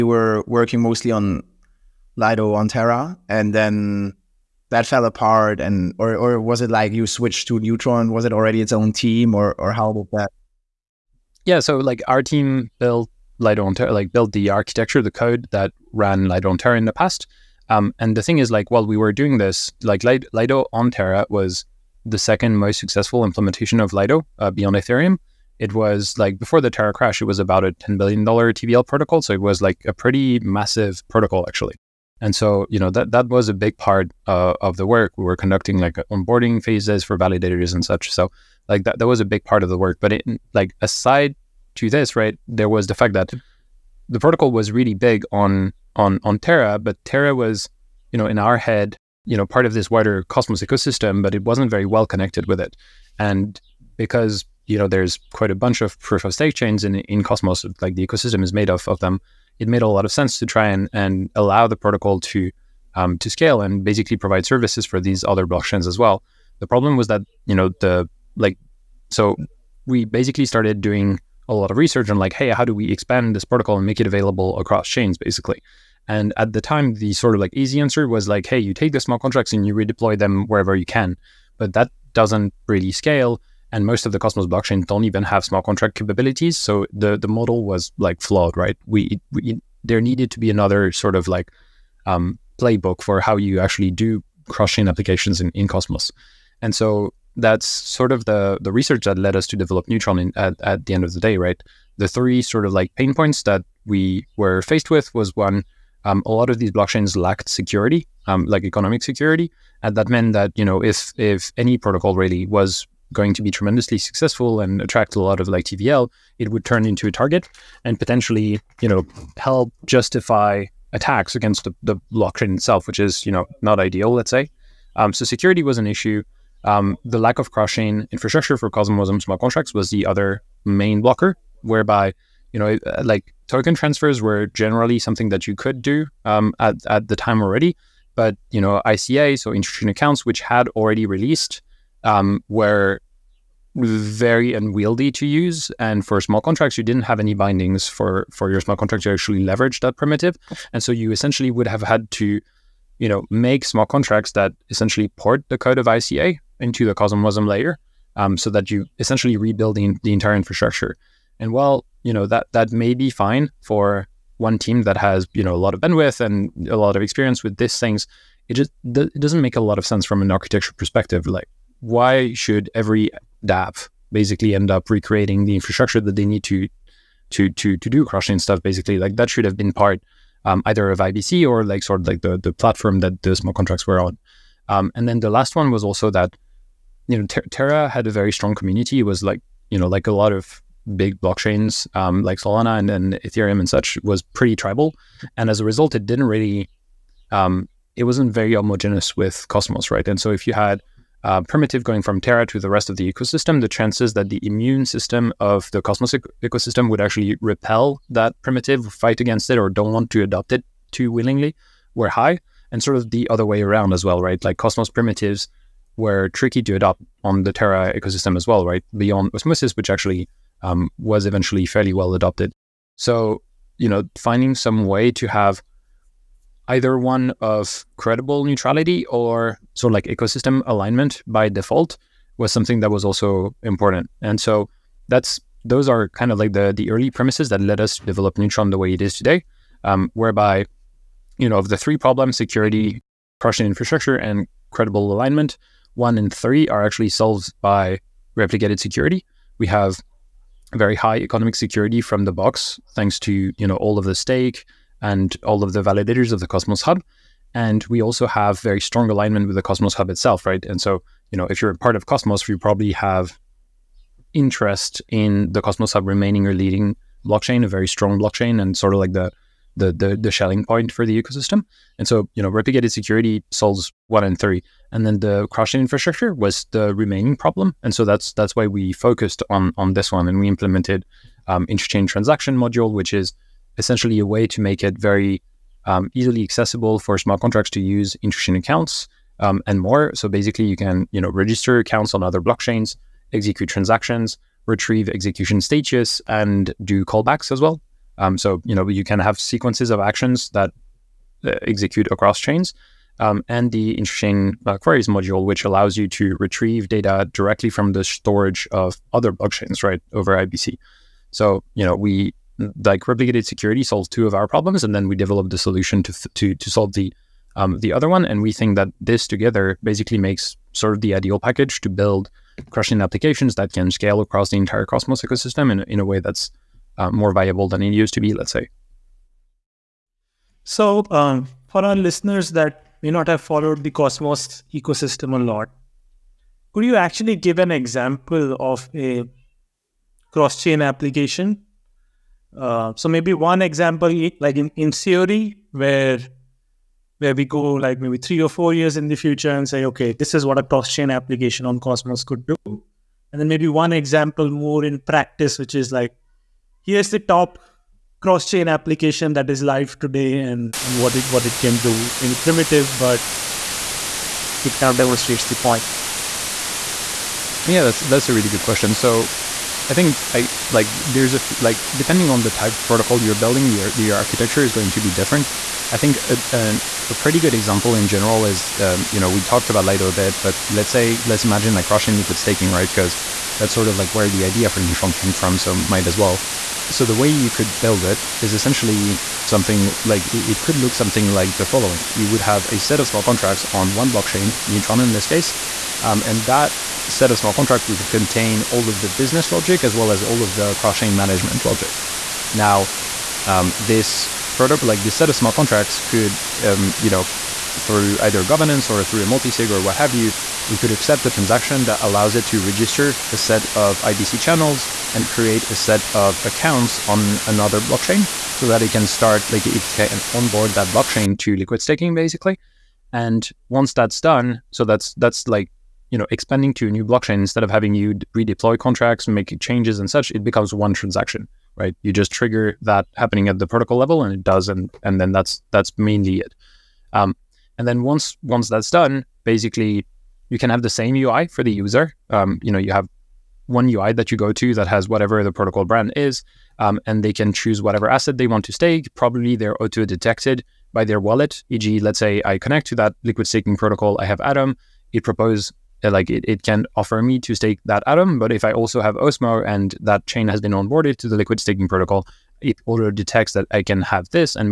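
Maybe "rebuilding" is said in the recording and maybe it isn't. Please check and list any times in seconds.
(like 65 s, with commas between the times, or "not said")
159 s.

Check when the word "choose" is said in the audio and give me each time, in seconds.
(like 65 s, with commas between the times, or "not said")
447 s.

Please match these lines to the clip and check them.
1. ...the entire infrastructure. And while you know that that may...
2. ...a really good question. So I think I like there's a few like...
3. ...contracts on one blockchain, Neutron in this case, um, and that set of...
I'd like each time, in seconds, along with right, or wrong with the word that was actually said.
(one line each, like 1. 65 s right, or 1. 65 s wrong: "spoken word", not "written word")
1. 160 s right
2. 368 s right
3. 393 s right.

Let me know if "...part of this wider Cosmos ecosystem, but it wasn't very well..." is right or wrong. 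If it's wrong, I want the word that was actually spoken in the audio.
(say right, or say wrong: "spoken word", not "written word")
right.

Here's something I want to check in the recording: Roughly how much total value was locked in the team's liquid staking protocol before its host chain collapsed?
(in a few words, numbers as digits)
$10 billion.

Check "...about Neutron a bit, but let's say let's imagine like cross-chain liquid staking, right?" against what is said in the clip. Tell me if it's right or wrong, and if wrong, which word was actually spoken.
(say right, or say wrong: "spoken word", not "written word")
wrong: "Lido", not "Neutron".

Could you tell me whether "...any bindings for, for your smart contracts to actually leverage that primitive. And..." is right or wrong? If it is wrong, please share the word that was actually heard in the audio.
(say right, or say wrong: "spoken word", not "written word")
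right.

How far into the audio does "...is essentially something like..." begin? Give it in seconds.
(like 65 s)
388 s.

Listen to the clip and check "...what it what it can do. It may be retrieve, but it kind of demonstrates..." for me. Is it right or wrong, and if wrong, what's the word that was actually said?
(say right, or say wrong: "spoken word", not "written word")
wrong: "primitive", not "retrieve".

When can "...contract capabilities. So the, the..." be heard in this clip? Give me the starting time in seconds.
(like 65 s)
85 s.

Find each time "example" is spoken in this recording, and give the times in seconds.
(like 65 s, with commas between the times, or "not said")
337 s, 343 s, 353 s, 377 s.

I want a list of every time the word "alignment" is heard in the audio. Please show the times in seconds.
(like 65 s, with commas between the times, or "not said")
230 s, 245 s, 259 s.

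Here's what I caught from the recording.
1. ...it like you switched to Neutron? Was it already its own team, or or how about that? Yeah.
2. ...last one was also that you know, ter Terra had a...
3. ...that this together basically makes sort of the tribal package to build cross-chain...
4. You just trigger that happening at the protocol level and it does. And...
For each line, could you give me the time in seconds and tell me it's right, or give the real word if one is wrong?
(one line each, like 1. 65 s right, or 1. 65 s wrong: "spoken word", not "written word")
1. 6 s right
2. 185 s right
3. 318 s wrong: "ideal", not "tribal"
4. 432 s right.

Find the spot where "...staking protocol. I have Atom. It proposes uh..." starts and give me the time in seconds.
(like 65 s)
453 s.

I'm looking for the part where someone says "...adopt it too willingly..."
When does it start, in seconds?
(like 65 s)
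210 s.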